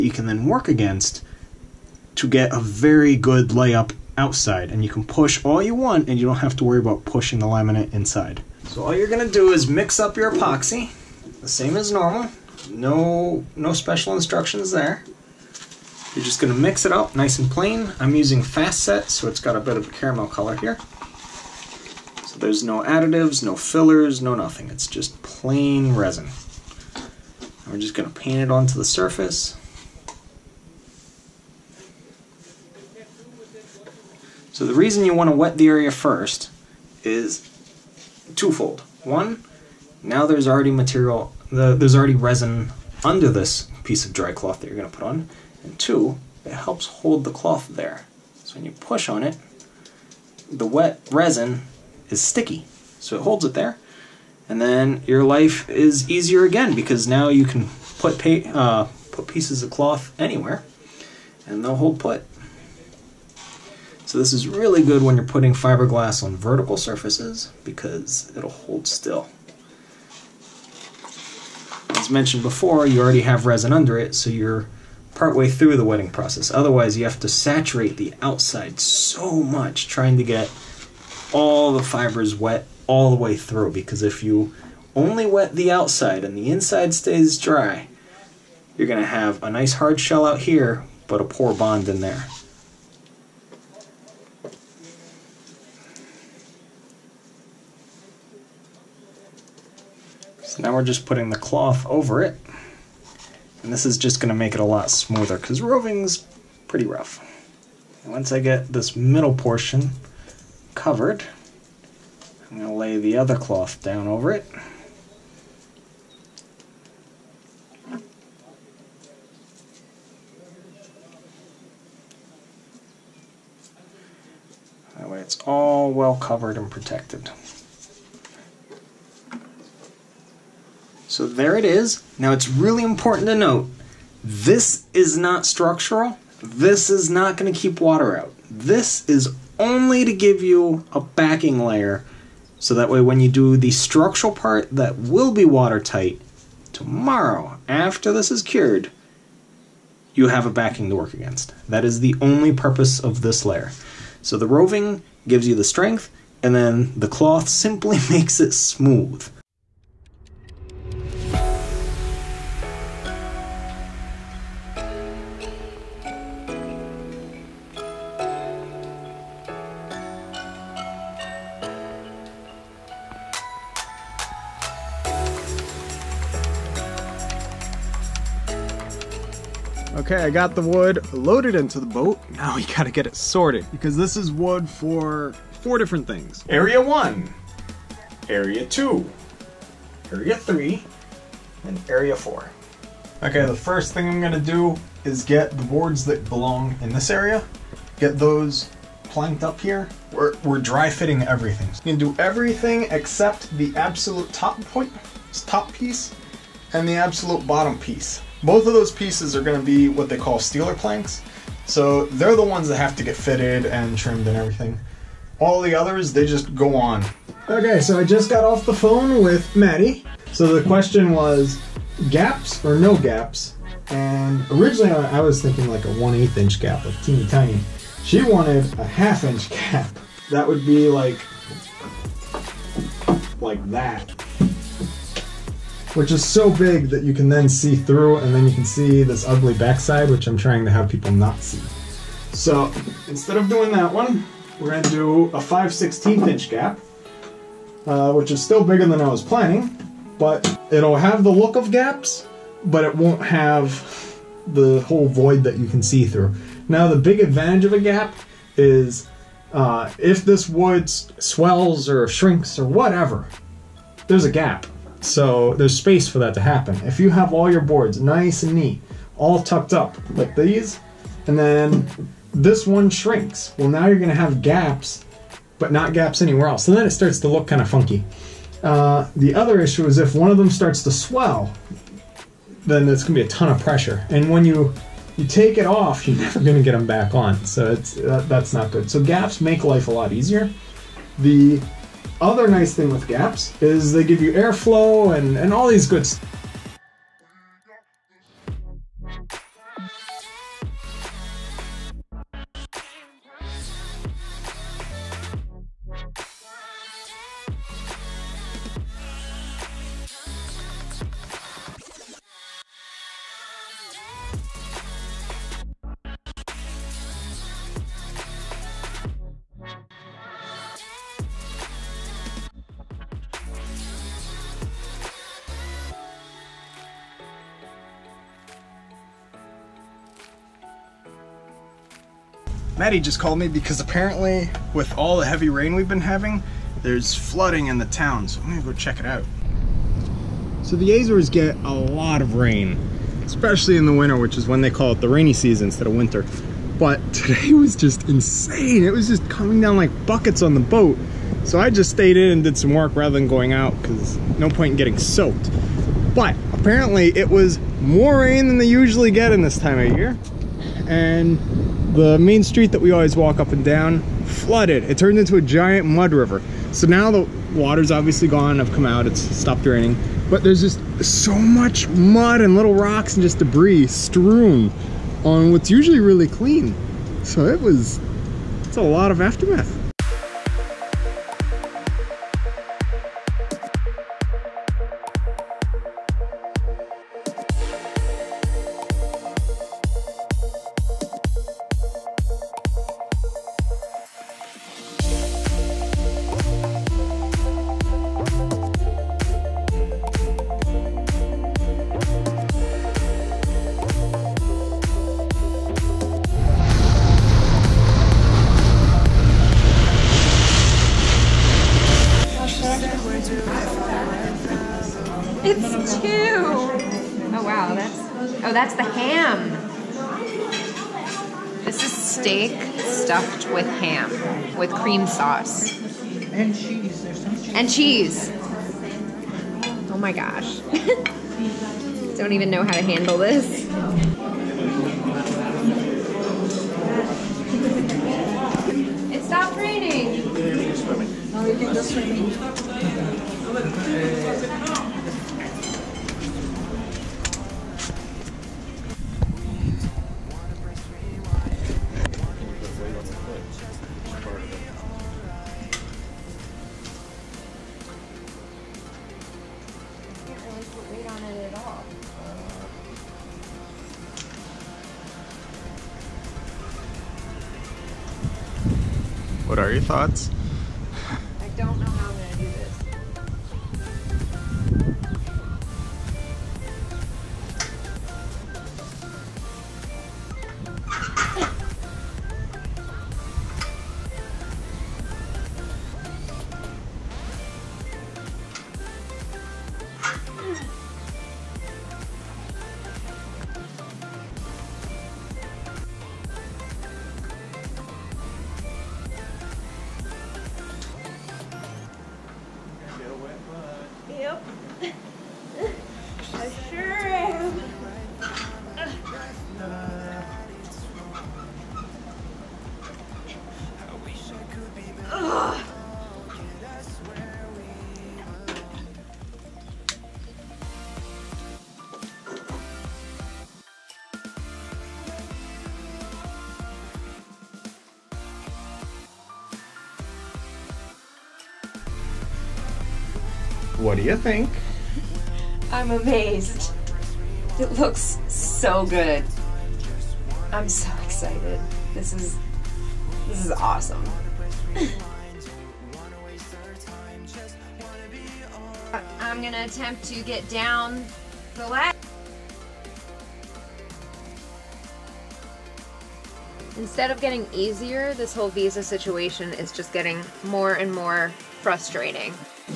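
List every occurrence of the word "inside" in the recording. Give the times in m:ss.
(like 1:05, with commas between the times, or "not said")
0:07, 1:26.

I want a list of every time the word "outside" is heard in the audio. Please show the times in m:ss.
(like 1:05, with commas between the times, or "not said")
0:04, 1:18, 1:25.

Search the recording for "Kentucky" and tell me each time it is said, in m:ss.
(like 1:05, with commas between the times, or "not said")
not said.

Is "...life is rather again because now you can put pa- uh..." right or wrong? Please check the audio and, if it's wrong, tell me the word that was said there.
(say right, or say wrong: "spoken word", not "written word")
wrong: "easier", not "rather".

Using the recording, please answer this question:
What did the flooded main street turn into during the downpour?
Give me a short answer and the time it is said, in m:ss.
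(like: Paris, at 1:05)
a giant mud river, at 6:05.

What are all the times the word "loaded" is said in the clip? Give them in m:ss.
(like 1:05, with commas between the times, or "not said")
3:01.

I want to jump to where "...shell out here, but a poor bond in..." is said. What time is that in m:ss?
1:30.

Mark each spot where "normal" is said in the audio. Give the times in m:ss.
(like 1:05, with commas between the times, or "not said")
0:11.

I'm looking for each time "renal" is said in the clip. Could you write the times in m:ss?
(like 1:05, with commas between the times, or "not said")
not said.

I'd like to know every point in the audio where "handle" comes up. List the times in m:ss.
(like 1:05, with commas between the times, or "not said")
7:12.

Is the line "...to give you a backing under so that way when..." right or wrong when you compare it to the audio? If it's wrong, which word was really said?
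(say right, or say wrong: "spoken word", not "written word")
wrong: "layer", not "under".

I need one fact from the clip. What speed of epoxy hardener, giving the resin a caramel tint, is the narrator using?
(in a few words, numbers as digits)
fast set.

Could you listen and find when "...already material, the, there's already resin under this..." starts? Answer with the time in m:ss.
0:40.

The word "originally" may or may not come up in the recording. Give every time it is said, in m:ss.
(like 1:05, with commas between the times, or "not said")
3:44.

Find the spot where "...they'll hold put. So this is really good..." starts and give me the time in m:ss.
1:01.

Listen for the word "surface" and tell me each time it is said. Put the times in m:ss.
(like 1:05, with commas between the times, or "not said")
0:28, 1:06.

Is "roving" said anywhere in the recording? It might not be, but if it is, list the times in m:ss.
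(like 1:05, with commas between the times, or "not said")
1:45, 2:34.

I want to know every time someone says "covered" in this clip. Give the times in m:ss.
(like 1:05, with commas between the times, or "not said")
1:50, 2:06.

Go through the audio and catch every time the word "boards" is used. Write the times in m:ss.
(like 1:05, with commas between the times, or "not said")
3:15, 4:27.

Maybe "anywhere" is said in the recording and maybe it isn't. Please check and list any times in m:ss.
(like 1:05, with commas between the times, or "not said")
1:00, 4:36.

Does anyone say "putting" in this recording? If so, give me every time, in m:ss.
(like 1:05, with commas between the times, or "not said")
1:05, 1:41.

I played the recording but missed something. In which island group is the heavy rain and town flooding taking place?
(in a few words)
the Azores.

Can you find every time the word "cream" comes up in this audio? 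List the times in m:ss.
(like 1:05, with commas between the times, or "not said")
7:04.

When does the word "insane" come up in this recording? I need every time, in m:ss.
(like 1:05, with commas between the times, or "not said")
5:48.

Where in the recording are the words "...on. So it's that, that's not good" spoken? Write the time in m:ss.
4:47.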